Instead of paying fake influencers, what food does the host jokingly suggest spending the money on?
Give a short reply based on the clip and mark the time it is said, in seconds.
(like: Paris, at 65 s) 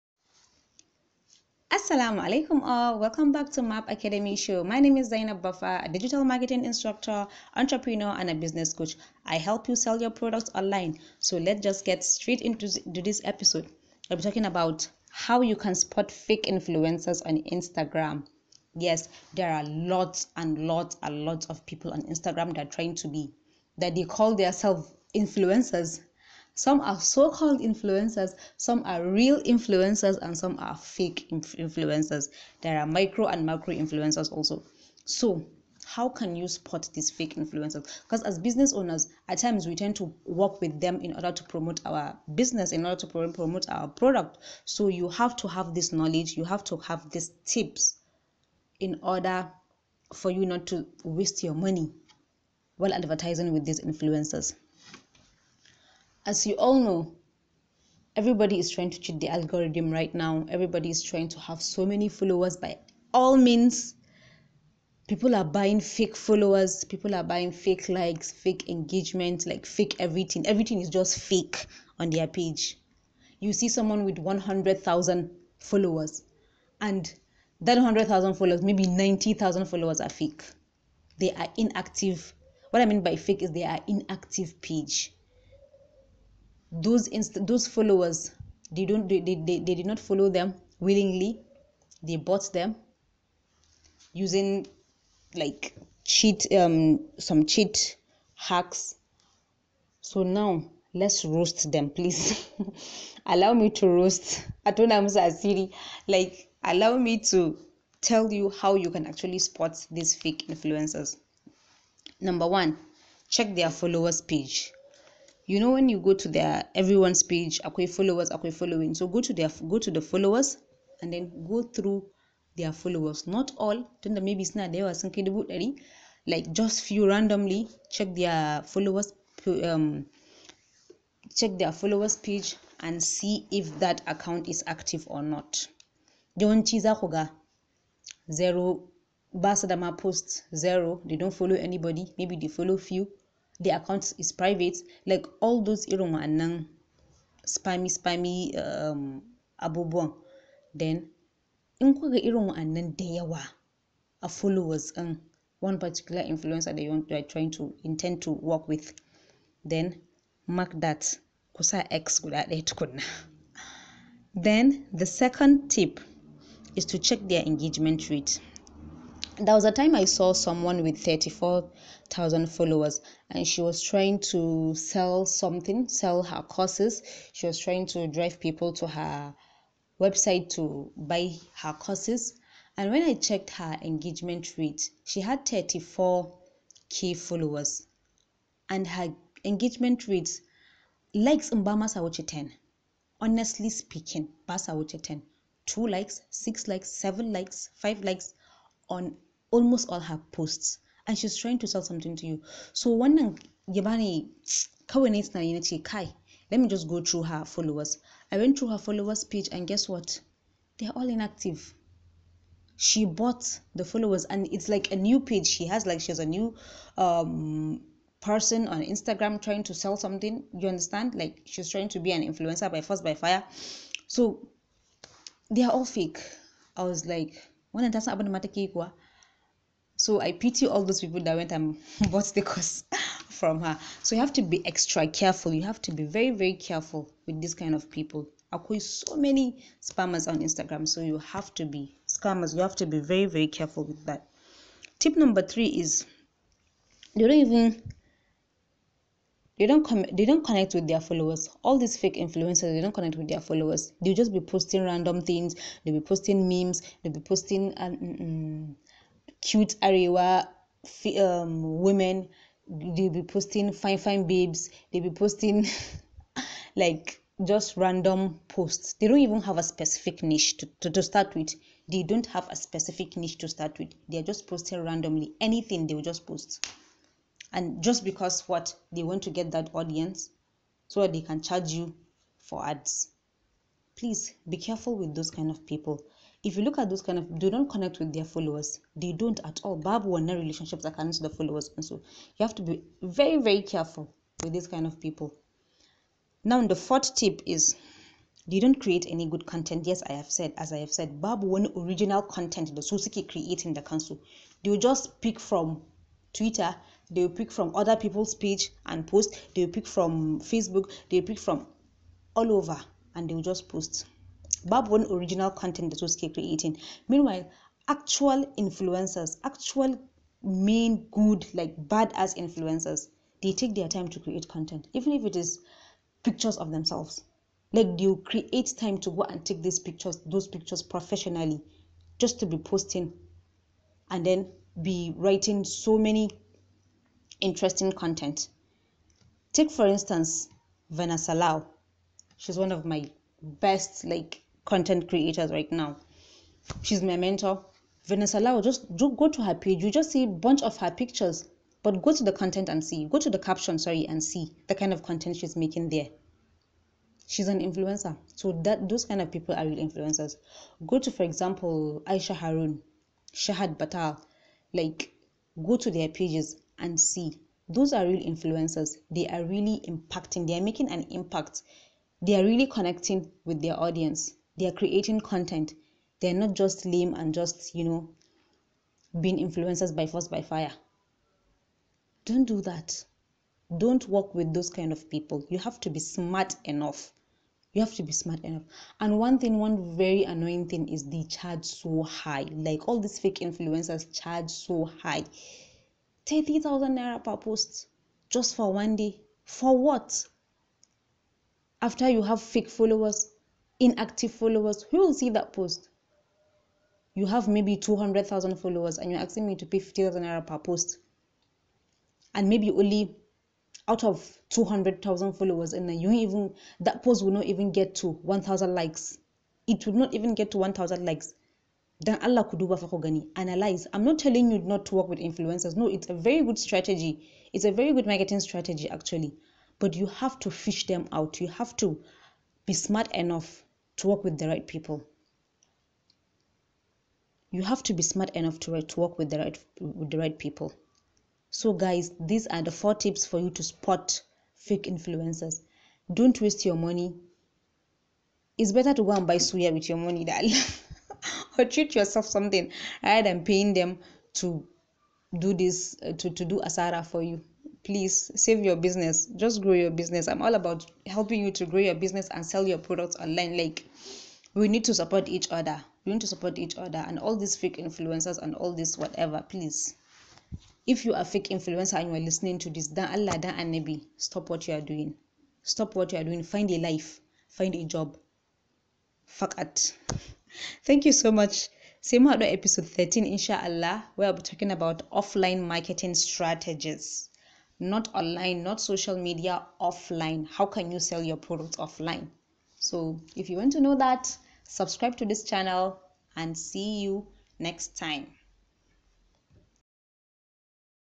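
Suya, at 449 s.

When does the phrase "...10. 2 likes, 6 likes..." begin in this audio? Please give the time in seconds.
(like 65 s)
195 s.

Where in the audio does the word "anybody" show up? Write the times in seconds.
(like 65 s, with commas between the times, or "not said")
141 s.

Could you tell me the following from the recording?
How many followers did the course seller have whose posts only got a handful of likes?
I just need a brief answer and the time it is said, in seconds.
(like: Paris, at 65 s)
34,000, at 171 s.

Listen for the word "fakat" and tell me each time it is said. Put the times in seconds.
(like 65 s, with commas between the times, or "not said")
479 s.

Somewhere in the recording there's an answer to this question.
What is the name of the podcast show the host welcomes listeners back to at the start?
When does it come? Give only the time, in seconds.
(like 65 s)
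3 s.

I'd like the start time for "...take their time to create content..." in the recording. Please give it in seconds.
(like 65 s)
323 s.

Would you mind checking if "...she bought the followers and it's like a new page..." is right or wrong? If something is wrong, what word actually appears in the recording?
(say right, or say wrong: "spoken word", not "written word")
right.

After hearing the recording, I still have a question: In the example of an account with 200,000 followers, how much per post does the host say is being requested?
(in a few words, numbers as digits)
50,000 naira.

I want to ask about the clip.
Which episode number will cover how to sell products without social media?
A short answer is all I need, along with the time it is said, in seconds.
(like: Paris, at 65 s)
13, at 482 s.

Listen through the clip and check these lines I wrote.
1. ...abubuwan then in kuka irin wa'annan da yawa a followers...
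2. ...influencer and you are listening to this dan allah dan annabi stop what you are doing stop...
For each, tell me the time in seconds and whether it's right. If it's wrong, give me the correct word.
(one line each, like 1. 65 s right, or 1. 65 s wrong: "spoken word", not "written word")
1. 149 s right
2. 471 s right.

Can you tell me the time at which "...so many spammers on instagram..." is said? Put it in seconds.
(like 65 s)
238 s.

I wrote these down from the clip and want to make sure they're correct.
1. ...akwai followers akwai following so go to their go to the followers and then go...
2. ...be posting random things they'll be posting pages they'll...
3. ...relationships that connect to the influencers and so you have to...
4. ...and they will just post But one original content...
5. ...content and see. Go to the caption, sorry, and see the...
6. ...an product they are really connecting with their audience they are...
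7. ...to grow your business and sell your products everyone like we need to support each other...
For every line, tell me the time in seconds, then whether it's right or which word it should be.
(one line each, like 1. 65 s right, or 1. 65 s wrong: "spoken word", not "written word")
1. 117 s right
2. 254 s wrong: "memes", not "pages"
3. 290 s wrong: "followers", not "influencers"
4. 313 s right
5. 352 s right
6. 370 s wrong: "impact", not "product"
7. 461 s wrong: "online", not "everyone".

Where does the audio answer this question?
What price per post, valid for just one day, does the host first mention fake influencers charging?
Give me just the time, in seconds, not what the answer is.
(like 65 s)
396 s.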